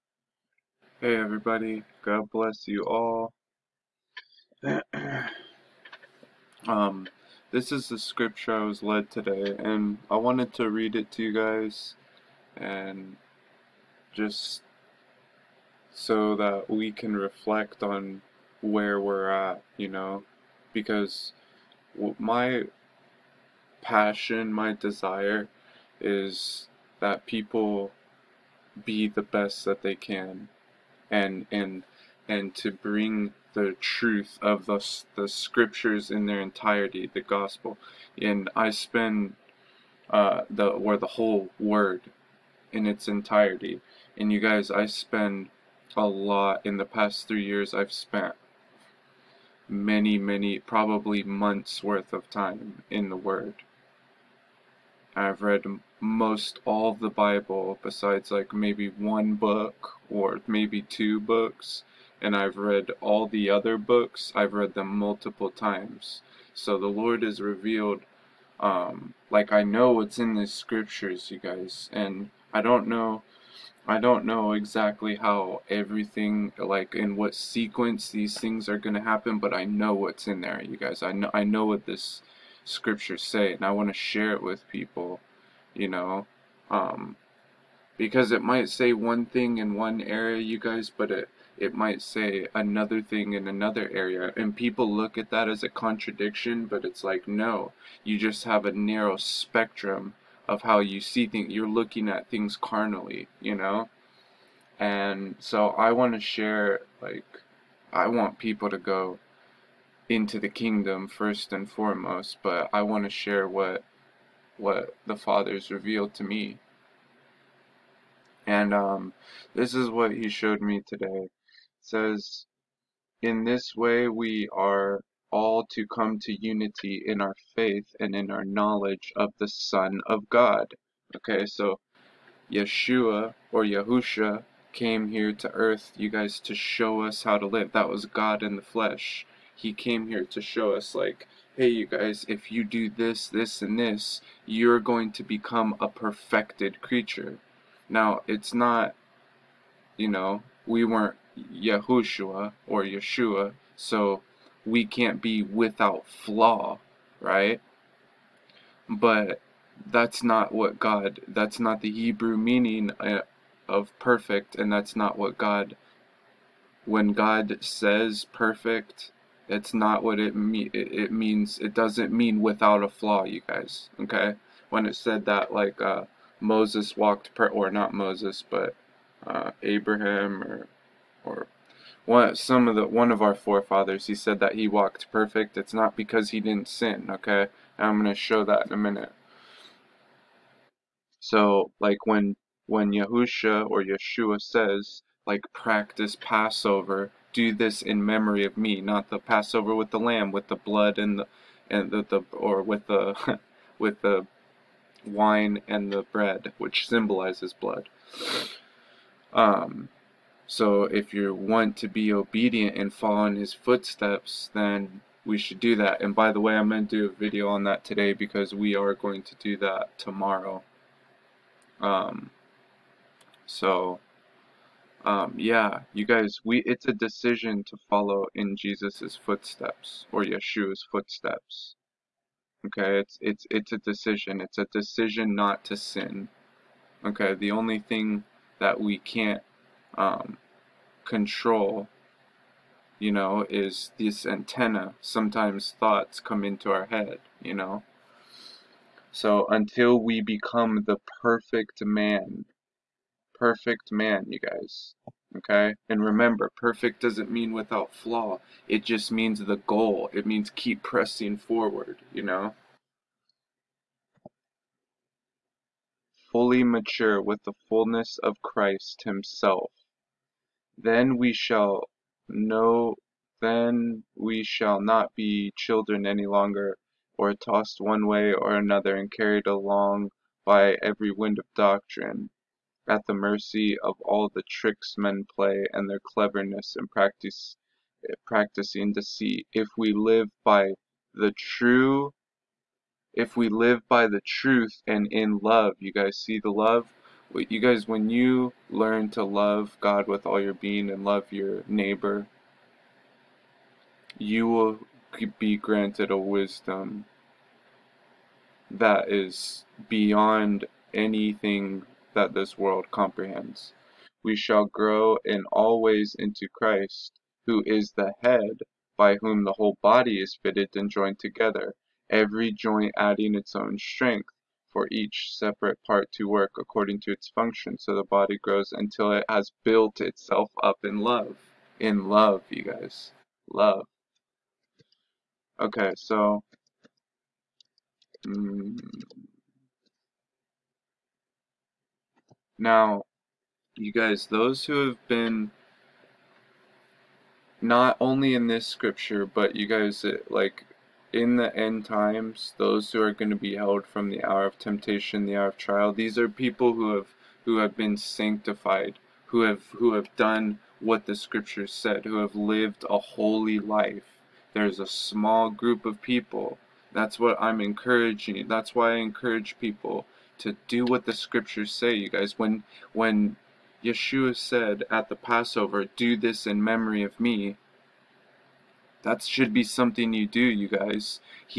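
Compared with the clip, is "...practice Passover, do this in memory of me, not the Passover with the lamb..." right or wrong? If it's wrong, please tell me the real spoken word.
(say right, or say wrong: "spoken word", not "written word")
right.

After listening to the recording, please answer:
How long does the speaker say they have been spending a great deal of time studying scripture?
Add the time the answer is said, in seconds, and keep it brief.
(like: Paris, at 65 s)
3 years, at 47 s.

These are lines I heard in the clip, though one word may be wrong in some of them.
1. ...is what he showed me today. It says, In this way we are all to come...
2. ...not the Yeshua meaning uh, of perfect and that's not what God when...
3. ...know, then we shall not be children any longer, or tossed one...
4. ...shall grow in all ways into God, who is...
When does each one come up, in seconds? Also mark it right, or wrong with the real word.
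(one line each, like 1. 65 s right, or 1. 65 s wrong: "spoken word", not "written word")
1. 119 s right
2. 161 s wrong: "Hebrew", not "Yeshua"
3. 272 s right
4. 314 s wrong: "Christ", not "God".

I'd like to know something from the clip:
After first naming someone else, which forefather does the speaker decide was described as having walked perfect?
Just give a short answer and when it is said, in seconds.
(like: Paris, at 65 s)
Abraham, at 179 s.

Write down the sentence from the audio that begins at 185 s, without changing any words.
It's not because he didn't sin, okay?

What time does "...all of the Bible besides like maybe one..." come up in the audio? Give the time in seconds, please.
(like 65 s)
56 s.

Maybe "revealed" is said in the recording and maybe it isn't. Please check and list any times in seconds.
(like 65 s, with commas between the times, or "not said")
67 s, 115 s.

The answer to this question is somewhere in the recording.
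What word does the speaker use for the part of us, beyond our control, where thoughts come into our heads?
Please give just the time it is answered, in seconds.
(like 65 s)
244 s.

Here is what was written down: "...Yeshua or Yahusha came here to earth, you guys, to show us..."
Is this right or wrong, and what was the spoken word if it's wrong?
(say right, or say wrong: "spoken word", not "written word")
right.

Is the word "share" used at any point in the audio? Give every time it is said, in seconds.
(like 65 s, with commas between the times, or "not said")
83 s, 106 s, 113 s.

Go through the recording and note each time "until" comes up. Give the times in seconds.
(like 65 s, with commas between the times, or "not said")
249 s, 328 s.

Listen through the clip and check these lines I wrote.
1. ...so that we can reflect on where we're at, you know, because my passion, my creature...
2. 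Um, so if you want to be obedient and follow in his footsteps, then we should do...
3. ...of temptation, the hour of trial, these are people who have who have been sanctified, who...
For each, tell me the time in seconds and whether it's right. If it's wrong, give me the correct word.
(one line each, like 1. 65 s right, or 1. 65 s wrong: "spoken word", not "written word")
1. 15 s wrong: "desire", not "creature"
2. 209 s right
3. 354 s right.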